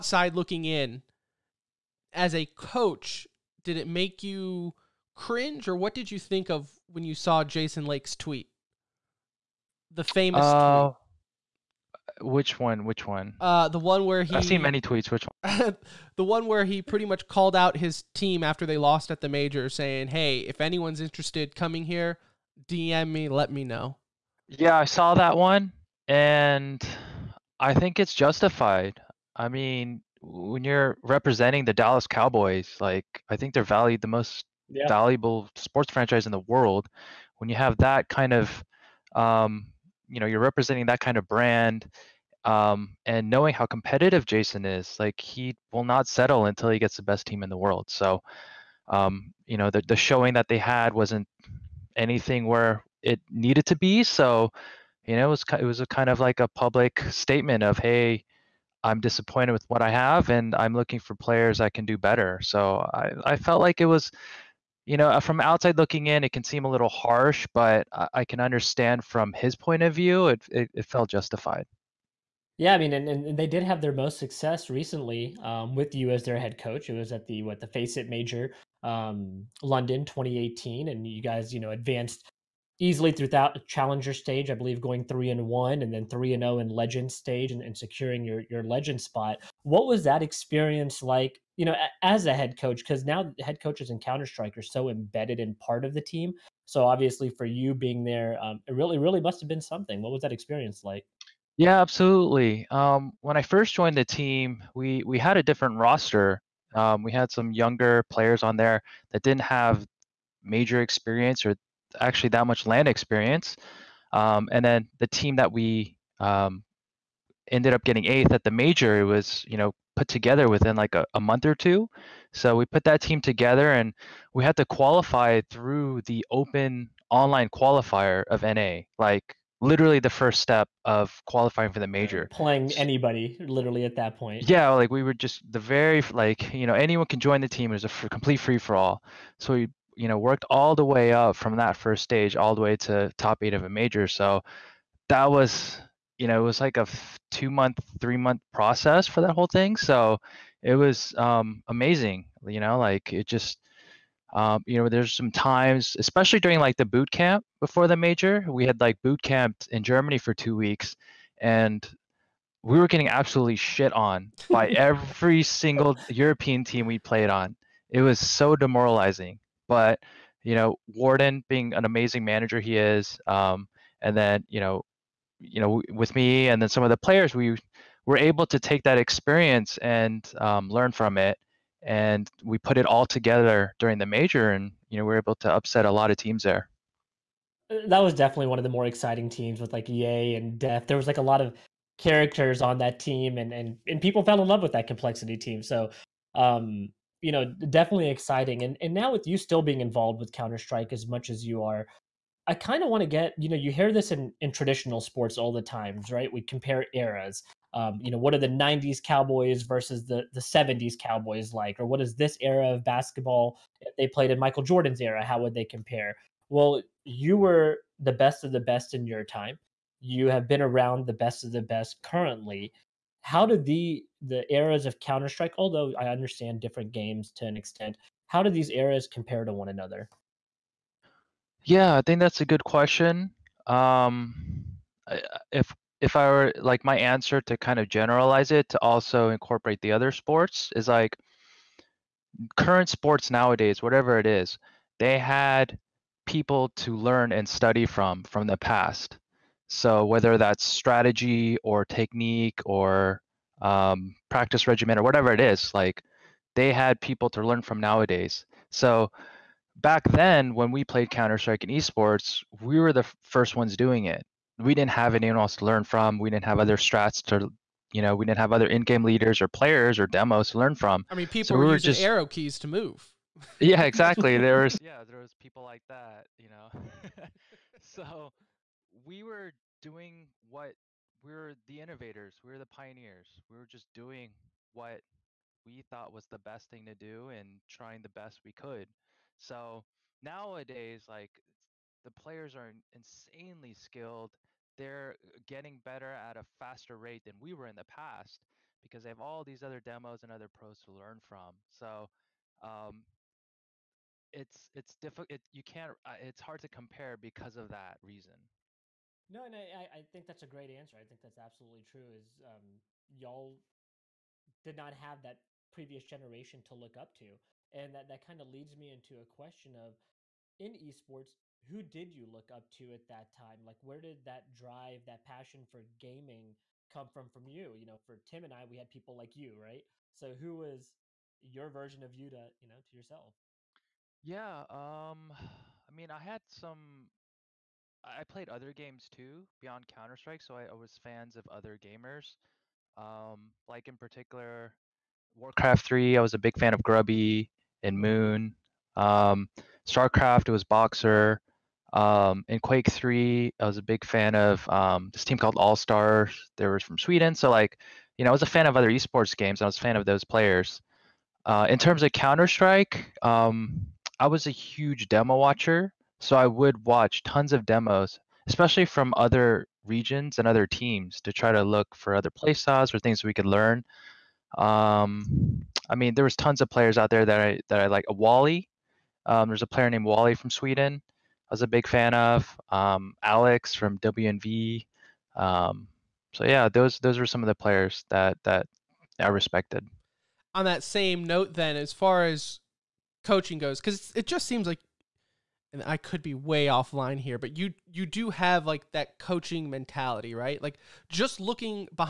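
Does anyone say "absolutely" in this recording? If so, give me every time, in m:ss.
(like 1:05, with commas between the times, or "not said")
1:41, 2:43, 5:11.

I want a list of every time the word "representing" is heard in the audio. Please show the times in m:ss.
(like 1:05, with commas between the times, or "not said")
0:31, 0:40.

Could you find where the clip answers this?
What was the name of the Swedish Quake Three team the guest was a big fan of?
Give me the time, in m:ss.
5:55.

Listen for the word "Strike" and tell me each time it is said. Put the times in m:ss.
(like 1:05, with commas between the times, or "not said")
1:34, 3:20, 3:45, 4:21, 5:40, 6:02.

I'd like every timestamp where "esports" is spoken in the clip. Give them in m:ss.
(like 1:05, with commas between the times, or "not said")
4:21, 5:20, 5:58.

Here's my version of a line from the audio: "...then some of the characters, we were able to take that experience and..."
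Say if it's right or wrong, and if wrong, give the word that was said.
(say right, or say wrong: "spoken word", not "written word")
wrong: "players", not "characters".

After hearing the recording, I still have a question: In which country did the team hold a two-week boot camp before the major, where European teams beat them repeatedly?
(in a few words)
Germany.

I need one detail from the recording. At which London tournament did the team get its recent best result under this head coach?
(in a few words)
FACEIT Major.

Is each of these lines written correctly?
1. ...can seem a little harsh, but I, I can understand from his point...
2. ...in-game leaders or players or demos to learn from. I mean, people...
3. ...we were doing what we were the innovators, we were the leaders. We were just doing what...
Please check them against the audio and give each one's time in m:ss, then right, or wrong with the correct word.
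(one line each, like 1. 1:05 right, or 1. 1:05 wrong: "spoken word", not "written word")
1. 1:06 right
2. 4:28 right
3. 4:38 wrong: "pioneers", not "leaders".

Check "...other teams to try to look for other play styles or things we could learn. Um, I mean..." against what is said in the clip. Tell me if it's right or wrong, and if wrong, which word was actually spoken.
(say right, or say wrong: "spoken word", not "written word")
right.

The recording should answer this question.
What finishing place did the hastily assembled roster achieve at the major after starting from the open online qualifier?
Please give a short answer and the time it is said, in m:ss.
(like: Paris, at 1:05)
Eighth, at 1:58.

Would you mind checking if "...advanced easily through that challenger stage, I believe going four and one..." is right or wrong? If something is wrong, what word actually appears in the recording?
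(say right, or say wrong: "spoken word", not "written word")
wrong: "three", not "four".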